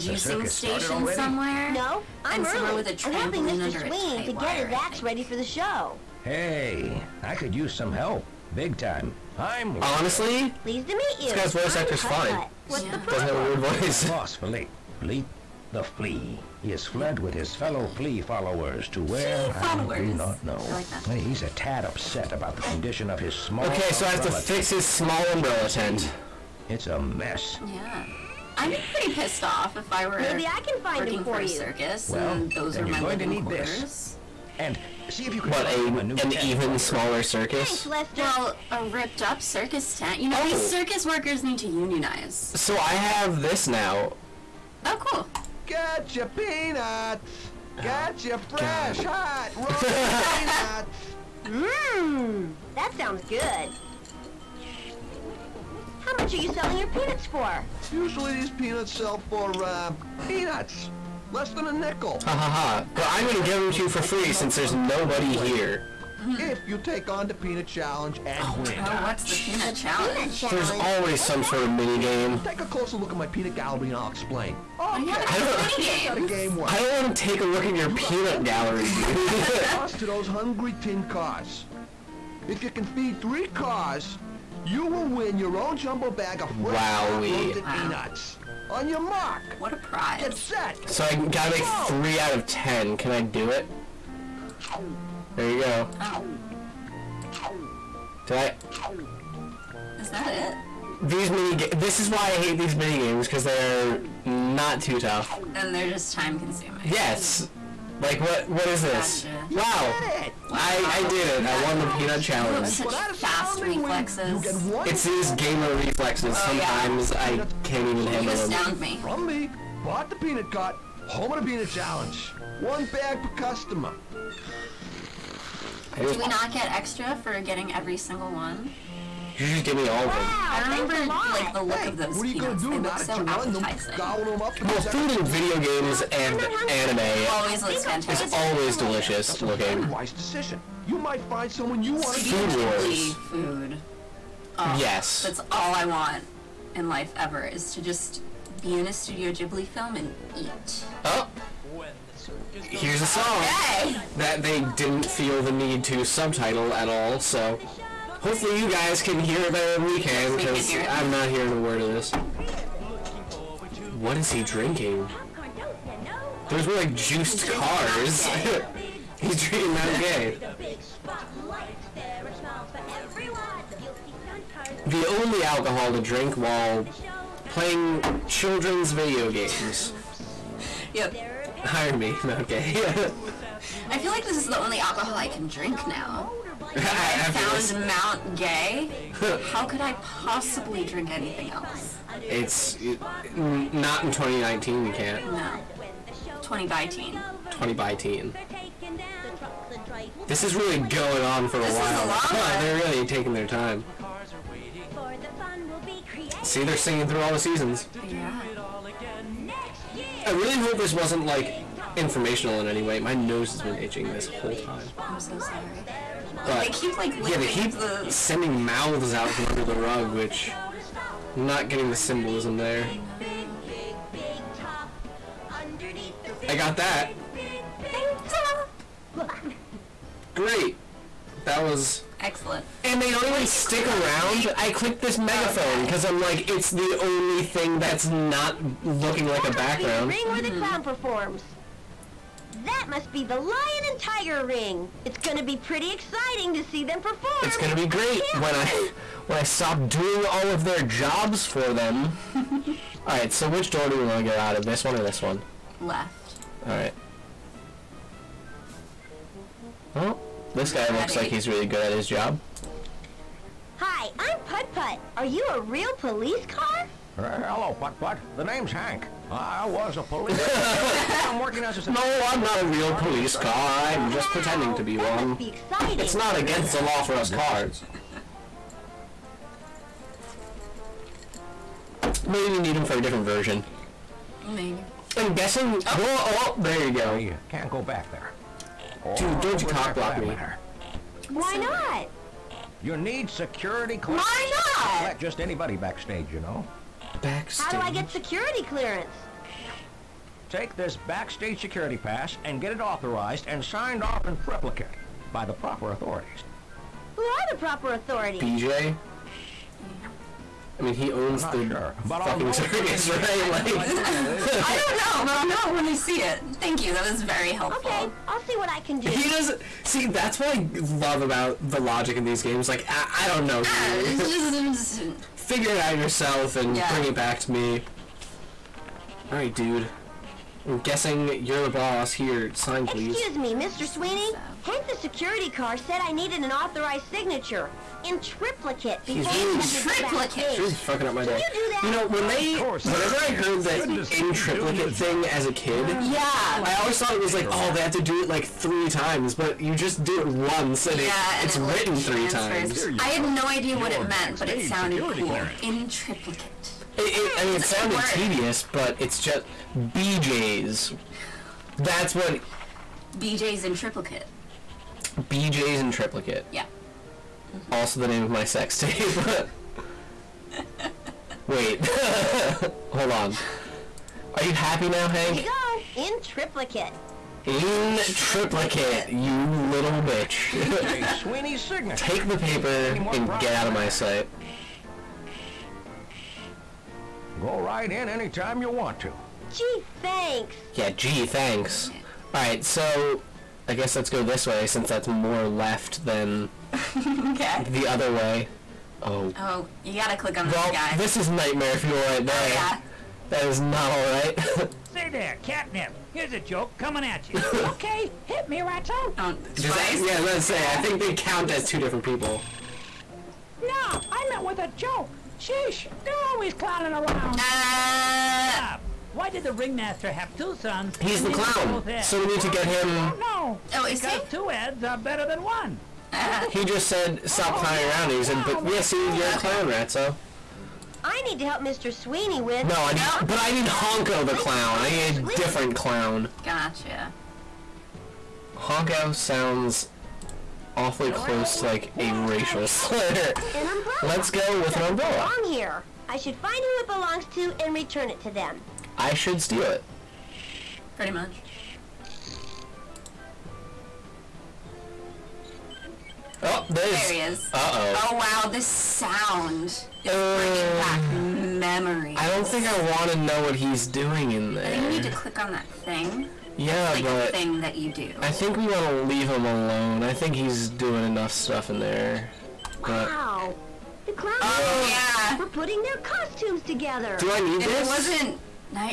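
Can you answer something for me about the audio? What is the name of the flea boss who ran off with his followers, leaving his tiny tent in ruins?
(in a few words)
Philippe.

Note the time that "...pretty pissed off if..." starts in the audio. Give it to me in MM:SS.
00:28.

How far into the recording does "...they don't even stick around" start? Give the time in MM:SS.
03:53.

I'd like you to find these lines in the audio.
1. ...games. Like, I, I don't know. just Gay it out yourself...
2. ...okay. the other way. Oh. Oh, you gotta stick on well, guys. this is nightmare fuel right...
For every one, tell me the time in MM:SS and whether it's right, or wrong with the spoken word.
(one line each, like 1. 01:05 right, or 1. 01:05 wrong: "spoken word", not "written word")
1. 05:22 wrong: "Figure", not "Gay"
2. 06:37 wrong: "click", not "stick".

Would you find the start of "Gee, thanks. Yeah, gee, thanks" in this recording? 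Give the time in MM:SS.
06:29.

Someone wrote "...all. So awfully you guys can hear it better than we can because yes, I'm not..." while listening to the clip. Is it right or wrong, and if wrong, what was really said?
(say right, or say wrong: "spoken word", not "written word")
wrong: "hopefully", not "awfully".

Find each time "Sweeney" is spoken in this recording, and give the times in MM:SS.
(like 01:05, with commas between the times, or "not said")
00:03, 05:33, 07:11.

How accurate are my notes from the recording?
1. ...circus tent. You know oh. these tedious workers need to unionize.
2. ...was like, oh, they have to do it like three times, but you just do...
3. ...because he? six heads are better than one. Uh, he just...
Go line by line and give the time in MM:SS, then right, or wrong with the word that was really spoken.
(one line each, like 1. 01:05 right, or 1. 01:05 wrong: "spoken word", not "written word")
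1. 00:39 wrong: "circus", not "tedious"
2. 05:47 right
3. 07:04 wrong: "two", not "six".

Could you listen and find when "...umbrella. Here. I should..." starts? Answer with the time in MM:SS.
07:24.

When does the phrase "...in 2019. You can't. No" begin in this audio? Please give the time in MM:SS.
03:14.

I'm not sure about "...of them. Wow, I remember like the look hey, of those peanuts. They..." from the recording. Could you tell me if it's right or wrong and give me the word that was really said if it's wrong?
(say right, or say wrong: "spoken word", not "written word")
right.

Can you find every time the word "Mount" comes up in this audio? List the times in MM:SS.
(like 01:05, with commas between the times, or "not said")
02:49, 03:02, 03:07.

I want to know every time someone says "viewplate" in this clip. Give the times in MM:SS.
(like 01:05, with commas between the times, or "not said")
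not said.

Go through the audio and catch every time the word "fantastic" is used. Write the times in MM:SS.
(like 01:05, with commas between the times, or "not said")
02:17.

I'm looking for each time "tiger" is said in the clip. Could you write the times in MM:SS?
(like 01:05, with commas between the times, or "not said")
04:03.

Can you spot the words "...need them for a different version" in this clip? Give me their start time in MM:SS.
04:42.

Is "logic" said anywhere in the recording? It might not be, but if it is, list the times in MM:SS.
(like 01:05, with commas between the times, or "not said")
05:21.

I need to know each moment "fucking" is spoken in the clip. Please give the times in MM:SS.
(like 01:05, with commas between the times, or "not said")
05:12, 05:40.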